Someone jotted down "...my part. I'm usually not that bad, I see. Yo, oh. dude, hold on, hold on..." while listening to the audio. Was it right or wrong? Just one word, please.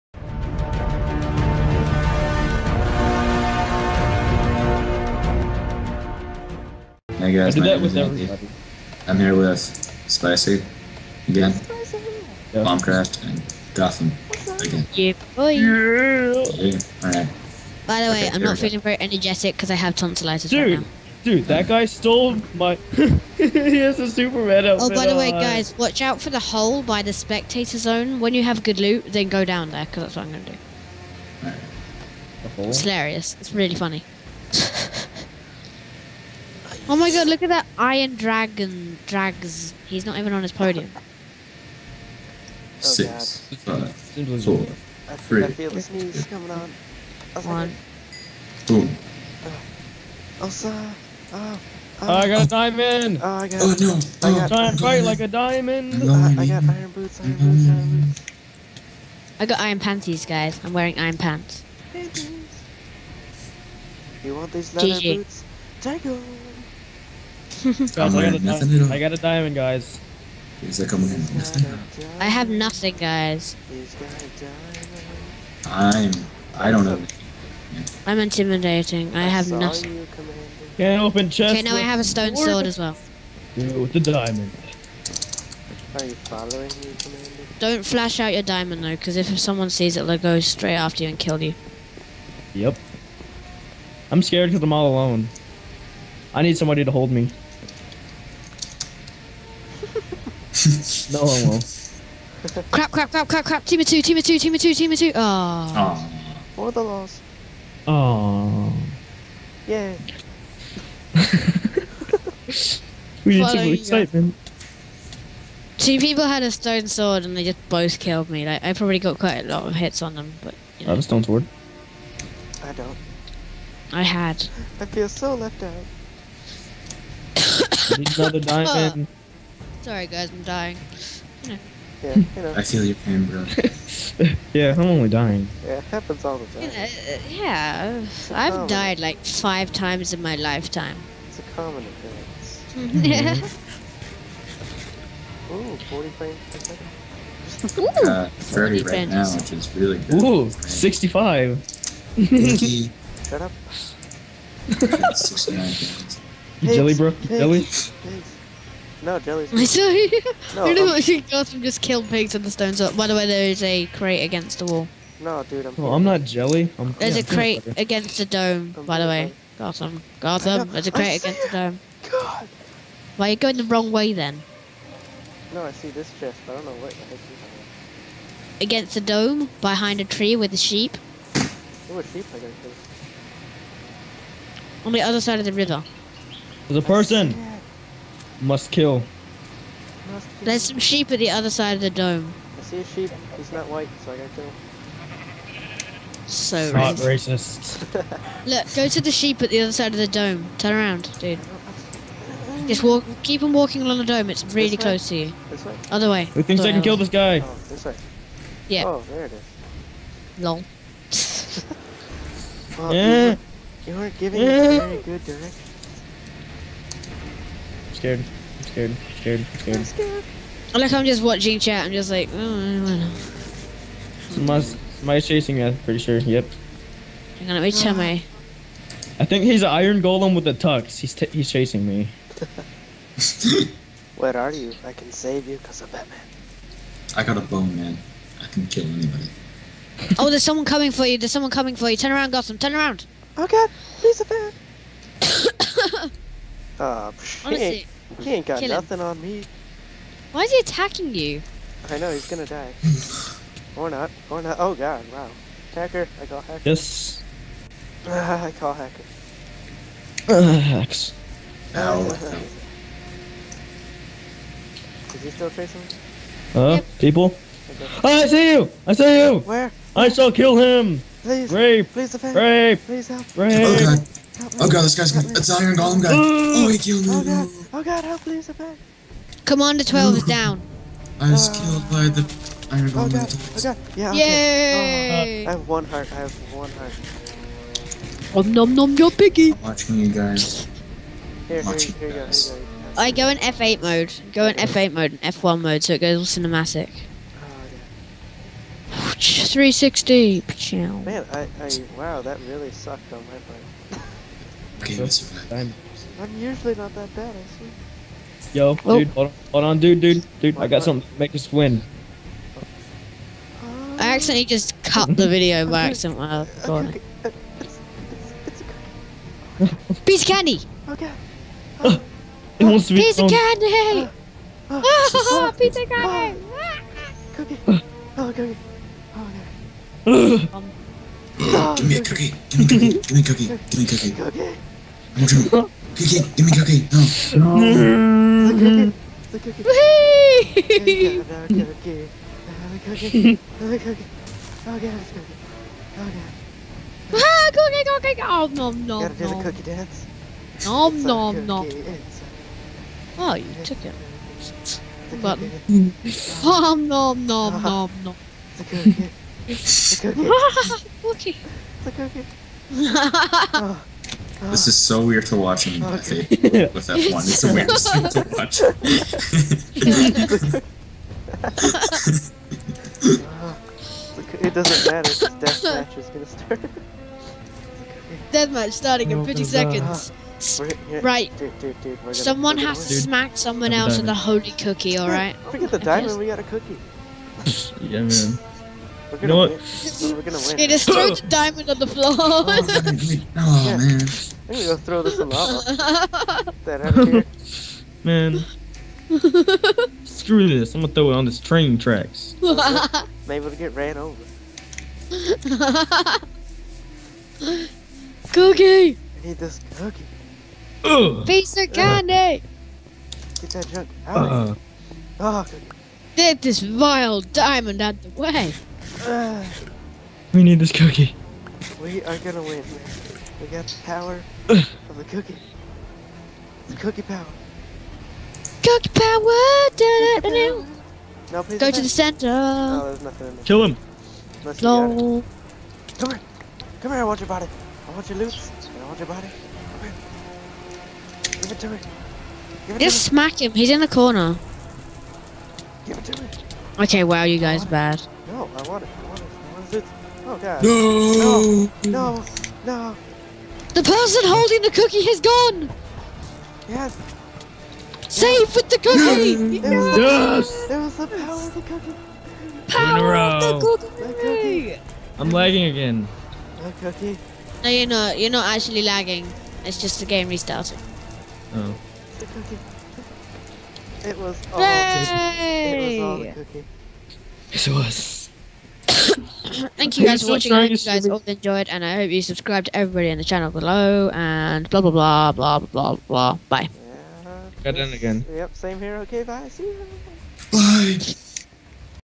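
right.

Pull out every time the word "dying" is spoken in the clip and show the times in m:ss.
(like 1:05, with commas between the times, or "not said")
2:10, 2:15.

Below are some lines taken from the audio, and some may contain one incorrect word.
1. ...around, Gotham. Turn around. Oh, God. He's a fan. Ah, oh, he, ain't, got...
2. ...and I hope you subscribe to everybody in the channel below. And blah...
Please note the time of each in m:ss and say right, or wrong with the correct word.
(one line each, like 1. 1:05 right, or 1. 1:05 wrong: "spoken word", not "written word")
1. 4:02 right
2. 8:01 right.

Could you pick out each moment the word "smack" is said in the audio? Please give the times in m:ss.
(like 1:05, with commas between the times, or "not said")
6:22, 7:23.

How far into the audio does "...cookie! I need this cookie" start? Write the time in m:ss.
6:48.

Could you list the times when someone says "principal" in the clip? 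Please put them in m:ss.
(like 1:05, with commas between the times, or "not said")
not said.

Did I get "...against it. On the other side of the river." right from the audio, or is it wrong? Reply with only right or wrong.
right.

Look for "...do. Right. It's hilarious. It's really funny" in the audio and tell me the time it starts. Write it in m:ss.
0:30.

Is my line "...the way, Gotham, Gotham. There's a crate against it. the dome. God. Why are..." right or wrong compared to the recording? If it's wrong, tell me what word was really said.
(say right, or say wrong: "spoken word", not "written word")
right.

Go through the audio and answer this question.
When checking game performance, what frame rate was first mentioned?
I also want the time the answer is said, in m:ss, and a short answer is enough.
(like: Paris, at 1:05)
40 frames per second, at 2:25.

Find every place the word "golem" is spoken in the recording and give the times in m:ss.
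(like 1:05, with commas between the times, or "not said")
3:50, 4:35, 4:43.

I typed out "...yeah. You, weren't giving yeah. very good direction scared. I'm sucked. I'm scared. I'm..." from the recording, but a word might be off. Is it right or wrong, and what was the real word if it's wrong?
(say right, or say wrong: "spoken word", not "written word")
wrong: "scared", not "sucked".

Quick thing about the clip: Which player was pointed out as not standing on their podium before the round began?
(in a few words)
Iron Dragon.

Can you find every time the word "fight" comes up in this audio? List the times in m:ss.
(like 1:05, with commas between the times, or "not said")
0:54.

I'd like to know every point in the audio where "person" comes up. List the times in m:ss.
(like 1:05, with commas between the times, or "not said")
3:06, 7:33.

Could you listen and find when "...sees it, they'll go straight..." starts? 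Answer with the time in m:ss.
1:29.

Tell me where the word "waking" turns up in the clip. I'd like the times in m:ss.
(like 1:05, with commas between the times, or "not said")
not said.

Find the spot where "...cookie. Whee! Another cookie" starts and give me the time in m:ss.
5:39.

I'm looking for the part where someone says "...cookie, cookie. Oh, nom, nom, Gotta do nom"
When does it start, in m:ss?
5:47.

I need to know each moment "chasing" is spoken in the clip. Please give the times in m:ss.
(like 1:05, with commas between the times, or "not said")
3:45, 3:51, 4:25.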